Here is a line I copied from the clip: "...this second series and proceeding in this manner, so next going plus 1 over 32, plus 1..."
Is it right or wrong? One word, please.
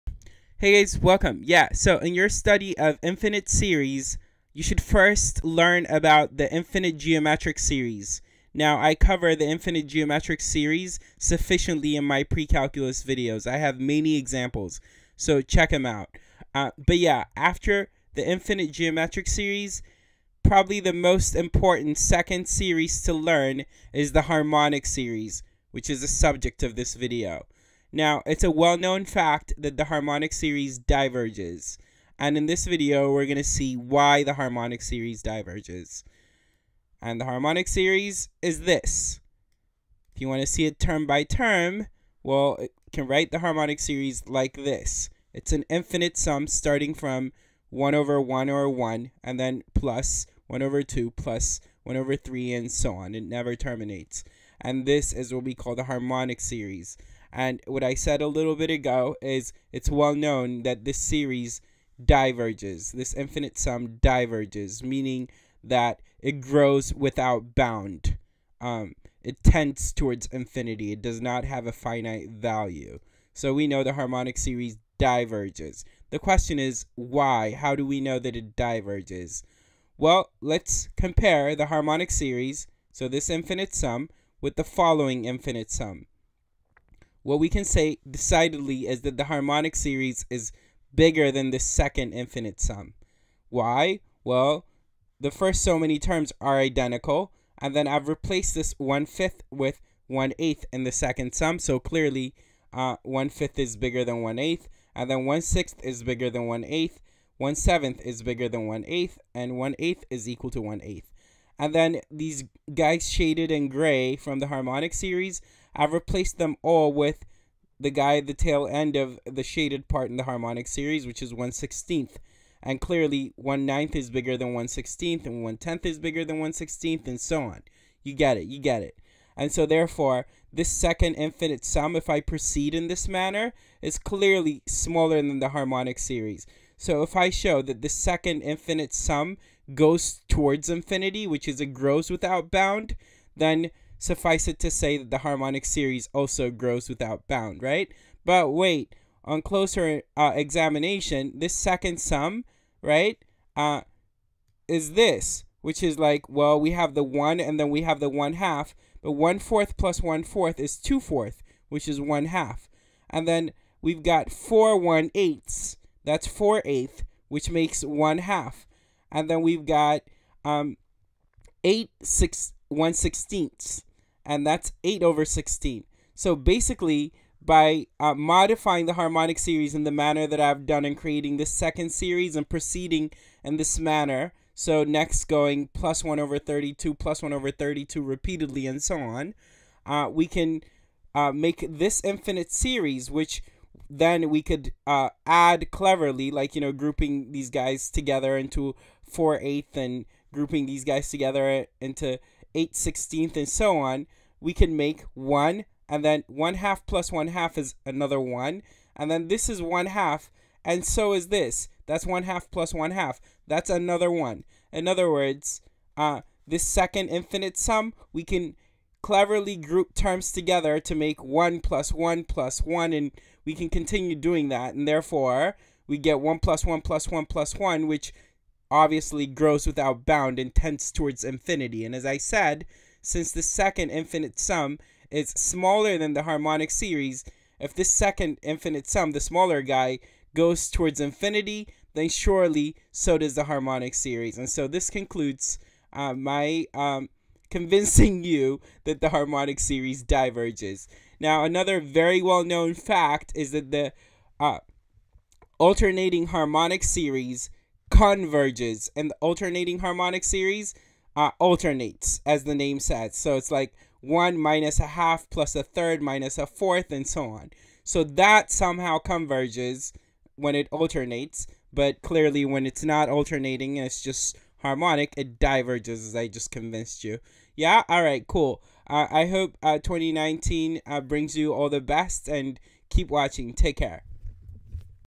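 right.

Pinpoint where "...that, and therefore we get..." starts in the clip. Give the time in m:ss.
3:44.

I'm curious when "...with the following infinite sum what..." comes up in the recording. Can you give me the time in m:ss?
1:24.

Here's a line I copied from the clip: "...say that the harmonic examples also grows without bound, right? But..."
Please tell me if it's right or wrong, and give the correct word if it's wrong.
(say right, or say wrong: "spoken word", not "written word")
wrong: "series", not "examples".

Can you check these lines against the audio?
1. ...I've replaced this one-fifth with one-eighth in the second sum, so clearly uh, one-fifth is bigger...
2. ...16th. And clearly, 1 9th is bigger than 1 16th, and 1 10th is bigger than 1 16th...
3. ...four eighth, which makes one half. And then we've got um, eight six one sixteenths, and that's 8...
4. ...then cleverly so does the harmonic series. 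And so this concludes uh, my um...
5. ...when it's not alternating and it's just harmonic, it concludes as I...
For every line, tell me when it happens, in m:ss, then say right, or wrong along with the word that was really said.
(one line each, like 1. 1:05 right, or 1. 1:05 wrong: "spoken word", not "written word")
1. 1:37 right
2. 2:01 right
3. 2:46 right
4. 4:01 wrong: "surely", not "cleverly"
5. 4:32 wrong: "diverges", not "concludes".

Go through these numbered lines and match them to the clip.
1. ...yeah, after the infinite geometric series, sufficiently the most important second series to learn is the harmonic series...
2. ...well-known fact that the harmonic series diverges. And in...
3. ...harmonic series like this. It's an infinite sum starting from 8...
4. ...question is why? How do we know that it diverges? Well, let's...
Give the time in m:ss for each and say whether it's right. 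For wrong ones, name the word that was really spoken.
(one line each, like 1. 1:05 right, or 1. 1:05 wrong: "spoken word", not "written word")
1. 0:16 wrong: "probably", not "sufficiently"
2. 0:28 right
3. 0:43 wrong: "1", not "8"
4. 1:16 right.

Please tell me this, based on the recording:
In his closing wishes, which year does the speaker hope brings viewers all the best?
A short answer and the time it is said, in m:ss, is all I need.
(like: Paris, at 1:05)
2019, at 4:39.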